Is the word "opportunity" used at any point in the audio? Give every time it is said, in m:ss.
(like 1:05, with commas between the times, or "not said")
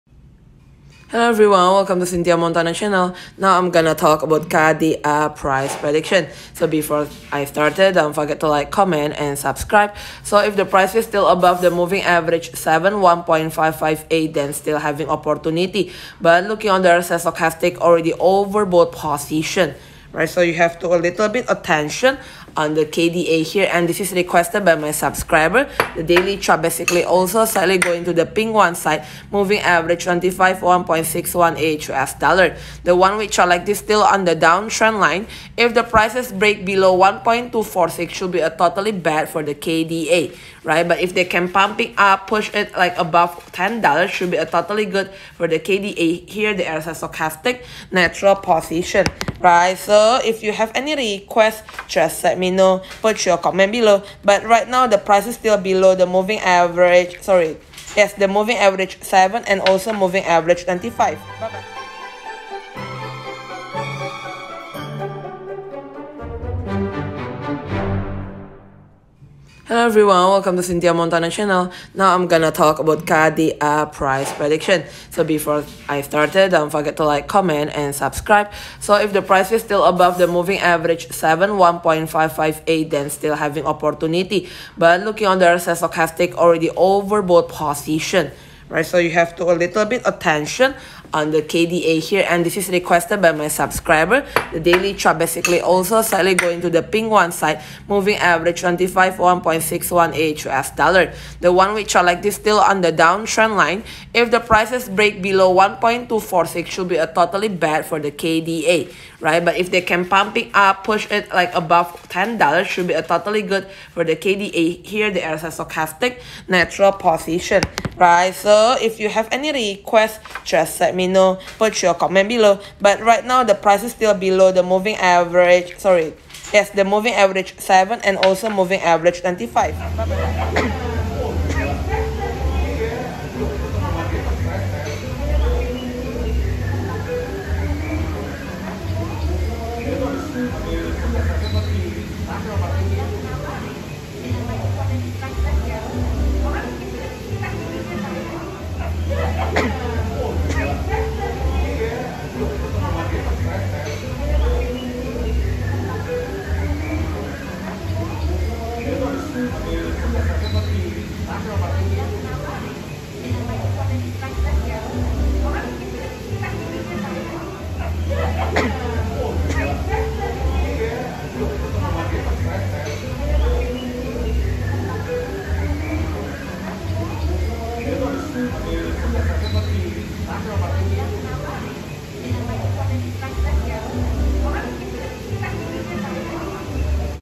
0:15, 1:23.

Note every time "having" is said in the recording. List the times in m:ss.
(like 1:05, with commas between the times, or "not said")
0:14, 1:23.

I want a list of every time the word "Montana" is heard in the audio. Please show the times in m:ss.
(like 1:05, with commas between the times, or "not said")
0:02, 1:10.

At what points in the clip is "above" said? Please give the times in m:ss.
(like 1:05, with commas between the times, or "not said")
0:11, 0:42, 1:19, 1:51.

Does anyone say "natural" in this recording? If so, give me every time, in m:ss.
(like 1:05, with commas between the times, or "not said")
0:47, 1:56.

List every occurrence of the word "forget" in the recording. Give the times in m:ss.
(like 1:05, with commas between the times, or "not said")
0:08, 1:16.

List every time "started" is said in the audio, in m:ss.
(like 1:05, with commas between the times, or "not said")
0:07, 1:16.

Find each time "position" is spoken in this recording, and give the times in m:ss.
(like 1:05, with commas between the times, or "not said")
0:18, 0:48, 1:27, 1:56.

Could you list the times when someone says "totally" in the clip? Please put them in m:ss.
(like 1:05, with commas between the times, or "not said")
0:38, 0:44, 1:47, 1:53.